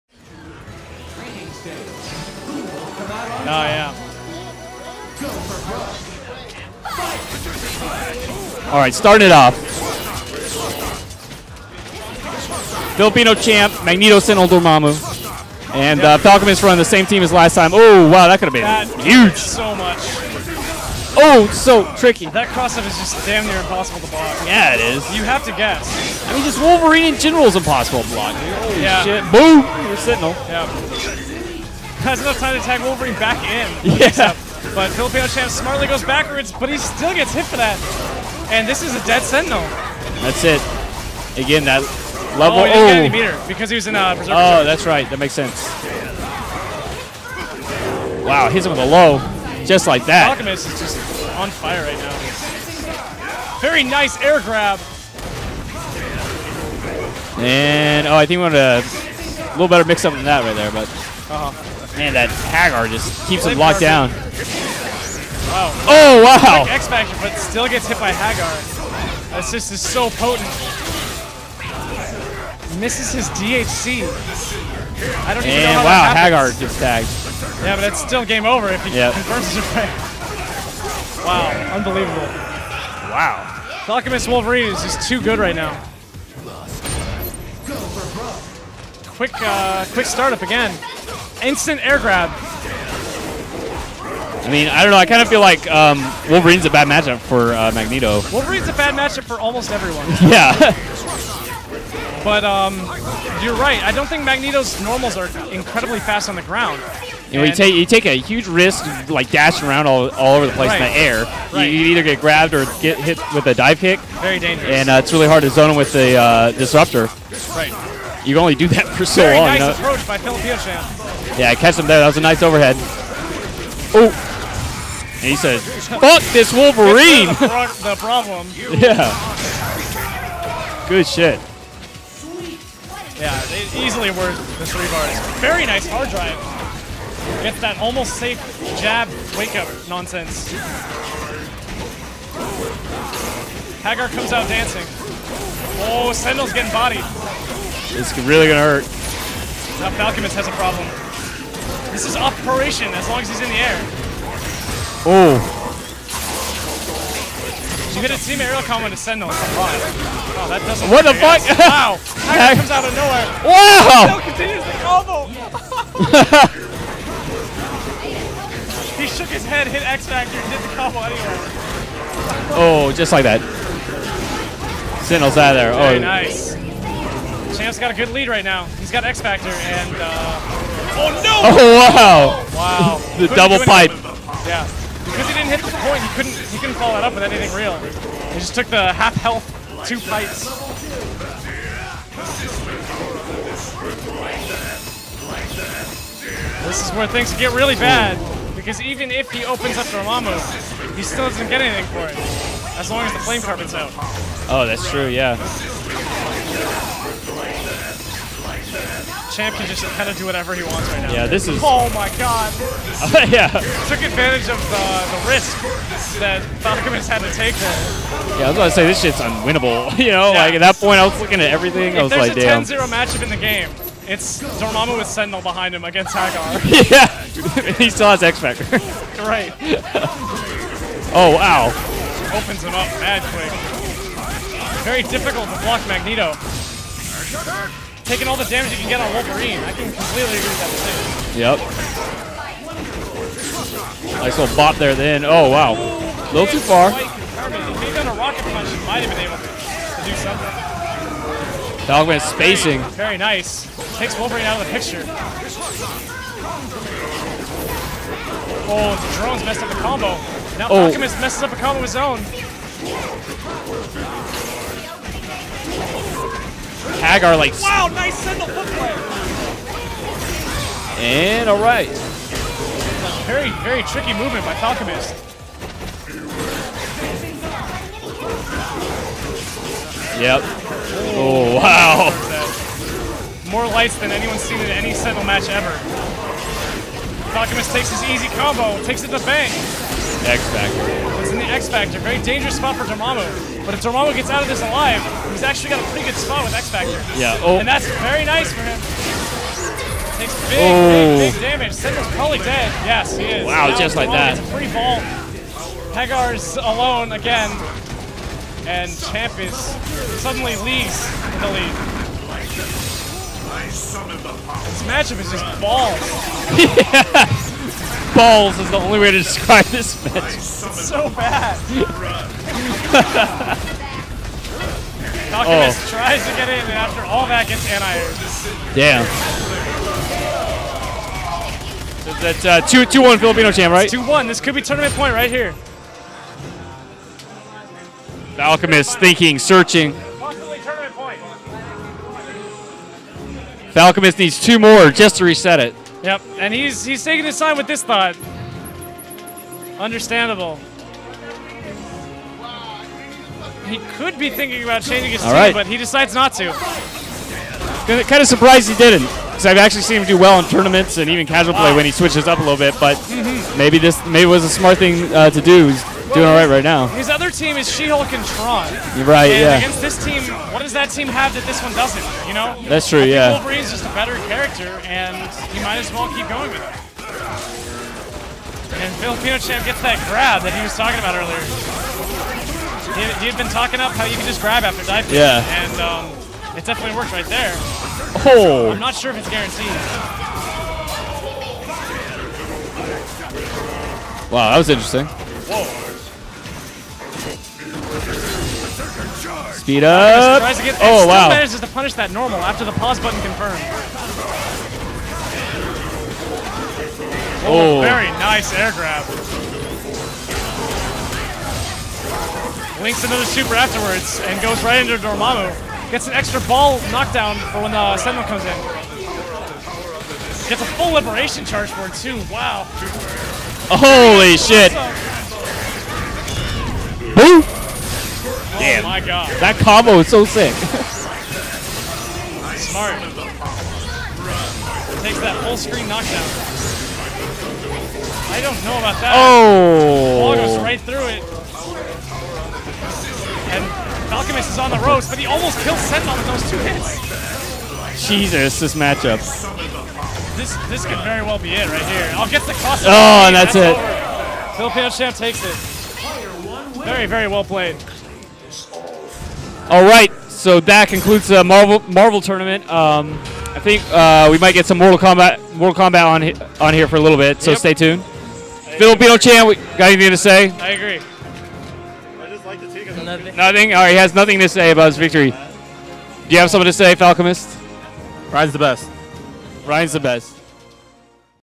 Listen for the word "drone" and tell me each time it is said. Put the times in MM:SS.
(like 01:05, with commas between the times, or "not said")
04:19.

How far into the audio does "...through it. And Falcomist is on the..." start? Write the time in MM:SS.
07:20.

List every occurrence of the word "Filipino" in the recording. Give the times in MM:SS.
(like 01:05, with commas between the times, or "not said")
00:12, 00:34, 05:33, 06:18, 07:34, 07:48.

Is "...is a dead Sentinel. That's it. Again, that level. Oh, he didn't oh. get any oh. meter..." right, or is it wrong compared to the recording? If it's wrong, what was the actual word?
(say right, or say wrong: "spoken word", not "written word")
right.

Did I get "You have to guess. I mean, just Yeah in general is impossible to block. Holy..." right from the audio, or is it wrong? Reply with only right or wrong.
wrong.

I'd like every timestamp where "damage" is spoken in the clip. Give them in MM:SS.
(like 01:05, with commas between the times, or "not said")
03:58, 05:01.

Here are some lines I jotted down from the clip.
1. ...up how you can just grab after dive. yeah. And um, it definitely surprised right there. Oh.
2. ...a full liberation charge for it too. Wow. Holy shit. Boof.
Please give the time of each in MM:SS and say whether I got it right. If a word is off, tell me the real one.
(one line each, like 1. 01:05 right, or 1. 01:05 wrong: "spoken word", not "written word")
1. 06:23 wrong: "worked", not "surprised"
2. 07:00 right.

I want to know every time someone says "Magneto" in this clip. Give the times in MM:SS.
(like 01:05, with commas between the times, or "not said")
00:13, 01:37, 01:44, 03:55.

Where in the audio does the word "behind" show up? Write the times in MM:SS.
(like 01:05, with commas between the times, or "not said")
03:45.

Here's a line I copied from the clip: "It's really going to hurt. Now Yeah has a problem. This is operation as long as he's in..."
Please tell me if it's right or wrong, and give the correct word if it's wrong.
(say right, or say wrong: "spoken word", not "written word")
wrong: "Falcomist", not "Yeah".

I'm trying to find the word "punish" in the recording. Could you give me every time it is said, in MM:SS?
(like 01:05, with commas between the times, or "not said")
06:41.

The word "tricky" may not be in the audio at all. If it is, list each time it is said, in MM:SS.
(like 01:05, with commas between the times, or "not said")
00:21, 04:33.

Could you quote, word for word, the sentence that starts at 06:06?
His other team is She-Hulk and Tron.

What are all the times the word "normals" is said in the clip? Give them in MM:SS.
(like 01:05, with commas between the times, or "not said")
01:44, 06:42.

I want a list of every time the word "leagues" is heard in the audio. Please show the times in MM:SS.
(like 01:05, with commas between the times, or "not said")
05:10.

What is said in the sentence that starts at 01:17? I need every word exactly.
Yeah, but it's still game over if he yep.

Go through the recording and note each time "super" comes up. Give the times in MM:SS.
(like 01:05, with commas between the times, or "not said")
06:53.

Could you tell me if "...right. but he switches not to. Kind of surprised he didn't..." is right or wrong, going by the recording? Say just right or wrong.
wrong.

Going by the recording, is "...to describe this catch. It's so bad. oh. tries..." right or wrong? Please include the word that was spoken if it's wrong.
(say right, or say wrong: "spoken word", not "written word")
wrong: "match", not "catch".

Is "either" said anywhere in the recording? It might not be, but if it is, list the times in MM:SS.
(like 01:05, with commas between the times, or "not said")
01:51.